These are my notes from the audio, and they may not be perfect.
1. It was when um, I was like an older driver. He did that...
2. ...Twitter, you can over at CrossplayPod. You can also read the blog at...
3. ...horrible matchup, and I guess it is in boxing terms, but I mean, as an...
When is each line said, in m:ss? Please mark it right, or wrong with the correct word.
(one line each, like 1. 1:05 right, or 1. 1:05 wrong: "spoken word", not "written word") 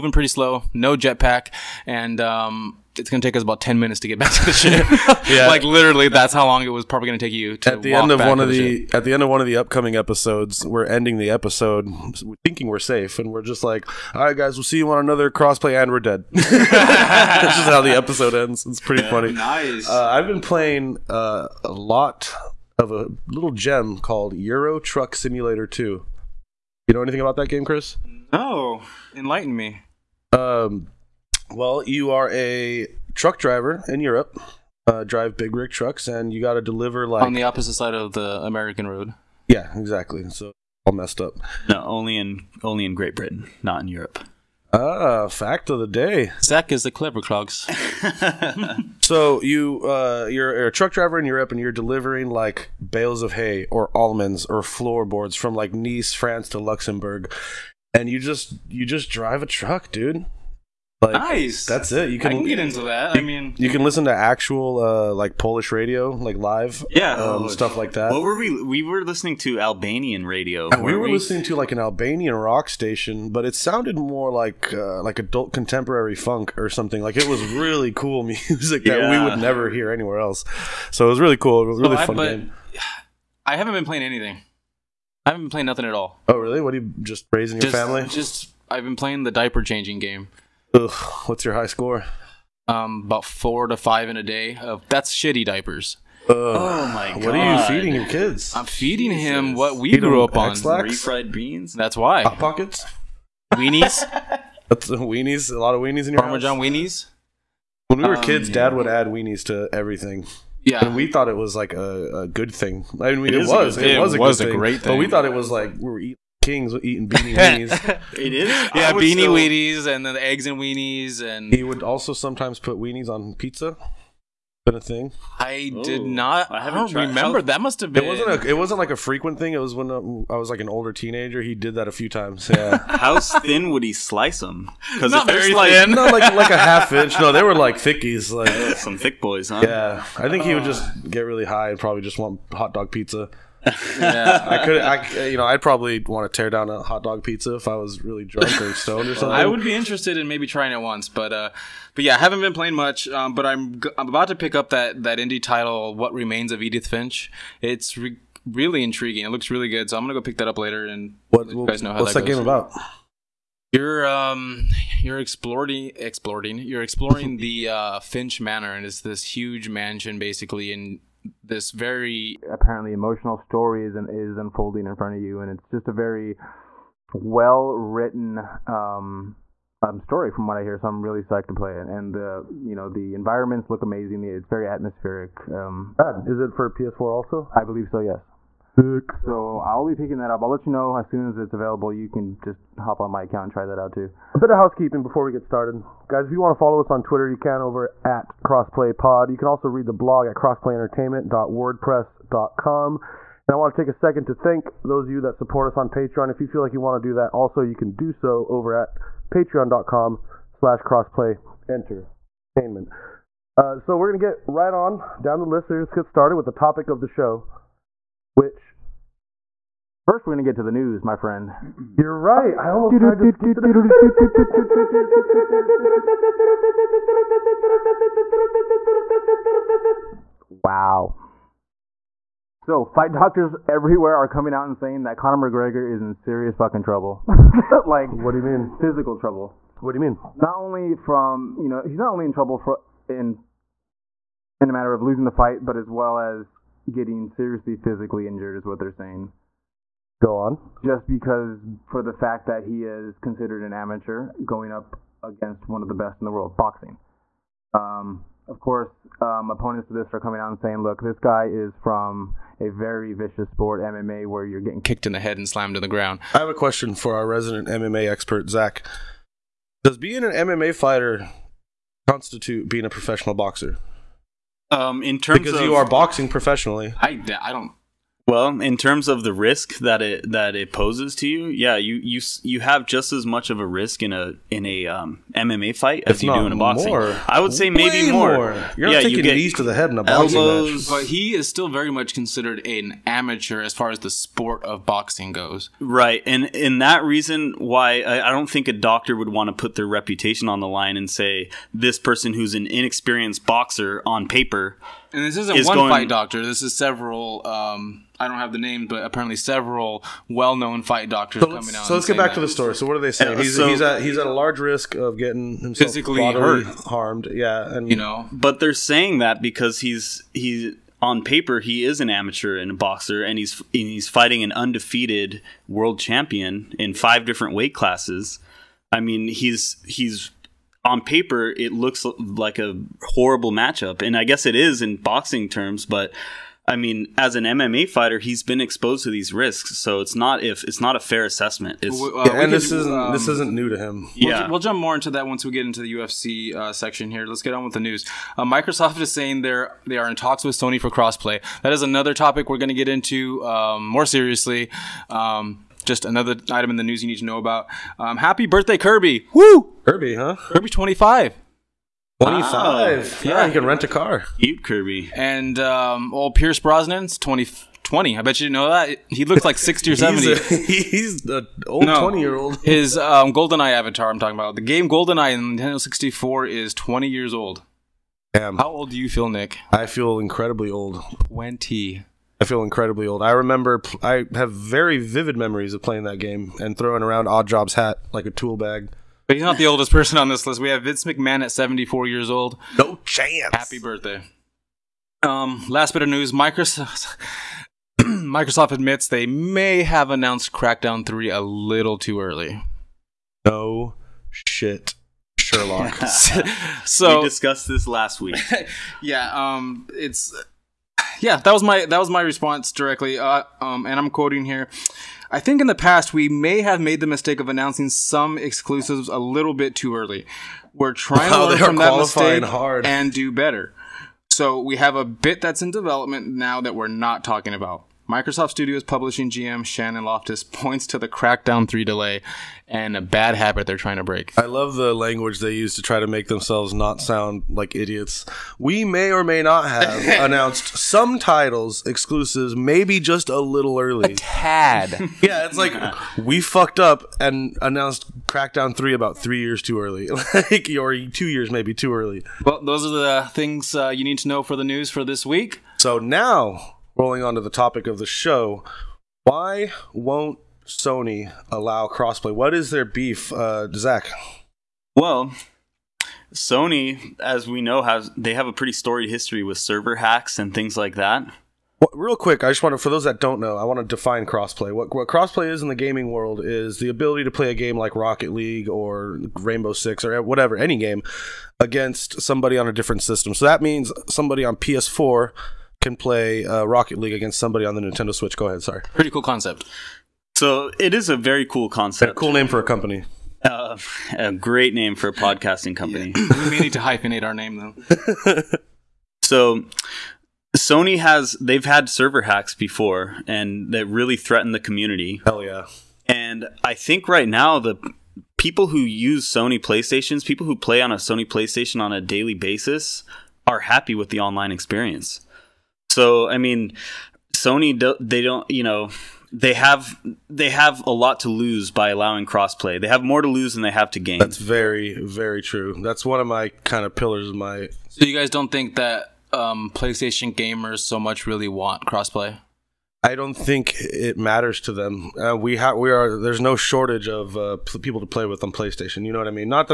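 1. 2:09 wrong: "teenager", not "driver"
2. 3:17 right
3. 5:33 right.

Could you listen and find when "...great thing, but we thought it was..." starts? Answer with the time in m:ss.
1:54.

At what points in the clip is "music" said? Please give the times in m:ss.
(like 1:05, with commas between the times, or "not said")
1:18.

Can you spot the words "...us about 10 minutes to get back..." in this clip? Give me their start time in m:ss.
0:03.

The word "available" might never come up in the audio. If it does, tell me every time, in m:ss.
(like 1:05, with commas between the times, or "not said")
3:11.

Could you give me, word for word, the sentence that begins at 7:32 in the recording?
Well, those are the things uh, you need to know for the news for this week.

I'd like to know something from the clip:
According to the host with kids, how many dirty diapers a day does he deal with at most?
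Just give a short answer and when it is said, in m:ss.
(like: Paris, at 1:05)
5, at 1:33.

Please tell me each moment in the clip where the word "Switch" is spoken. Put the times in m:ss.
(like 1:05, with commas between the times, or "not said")
8:08.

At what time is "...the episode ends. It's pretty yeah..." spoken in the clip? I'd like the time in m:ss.
0:17.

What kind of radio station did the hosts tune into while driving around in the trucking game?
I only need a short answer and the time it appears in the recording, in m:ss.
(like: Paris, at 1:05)
Albanian rock station, at 1:11.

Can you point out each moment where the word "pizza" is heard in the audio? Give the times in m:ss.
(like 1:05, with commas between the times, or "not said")
2:03, 2:22, 2:27.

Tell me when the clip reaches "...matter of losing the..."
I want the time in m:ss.
4:04.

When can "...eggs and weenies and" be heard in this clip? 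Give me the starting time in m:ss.
2:00.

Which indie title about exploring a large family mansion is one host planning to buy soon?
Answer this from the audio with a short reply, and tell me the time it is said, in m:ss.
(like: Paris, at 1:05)
What Remains of Edith Finch, at 2:35.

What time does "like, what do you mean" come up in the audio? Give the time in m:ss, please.
3:57.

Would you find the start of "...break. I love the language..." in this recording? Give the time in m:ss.
7:14.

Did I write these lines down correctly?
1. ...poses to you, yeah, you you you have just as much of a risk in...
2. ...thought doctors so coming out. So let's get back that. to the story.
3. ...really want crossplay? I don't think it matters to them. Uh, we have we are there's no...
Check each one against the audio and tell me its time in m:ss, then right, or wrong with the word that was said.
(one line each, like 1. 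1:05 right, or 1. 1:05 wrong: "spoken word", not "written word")
1. 4:40 right
2. 5:10 wrong: "fight", not "thought"
3. 8:51 right.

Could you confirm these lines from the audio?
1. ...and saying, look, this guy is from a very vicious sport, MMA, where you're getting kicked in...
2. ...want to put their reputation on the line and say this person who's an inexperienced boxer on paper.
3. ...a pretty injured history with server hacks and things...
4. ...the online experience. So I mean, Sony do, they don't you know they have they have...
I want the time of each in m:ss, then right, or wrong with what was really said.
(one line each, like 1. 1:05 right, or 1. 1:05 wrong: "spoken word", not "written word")
1. 4:20 right
2. 4:59 right
3. 7:48 wrong: "storied", not "injured"
4. 8:34 right.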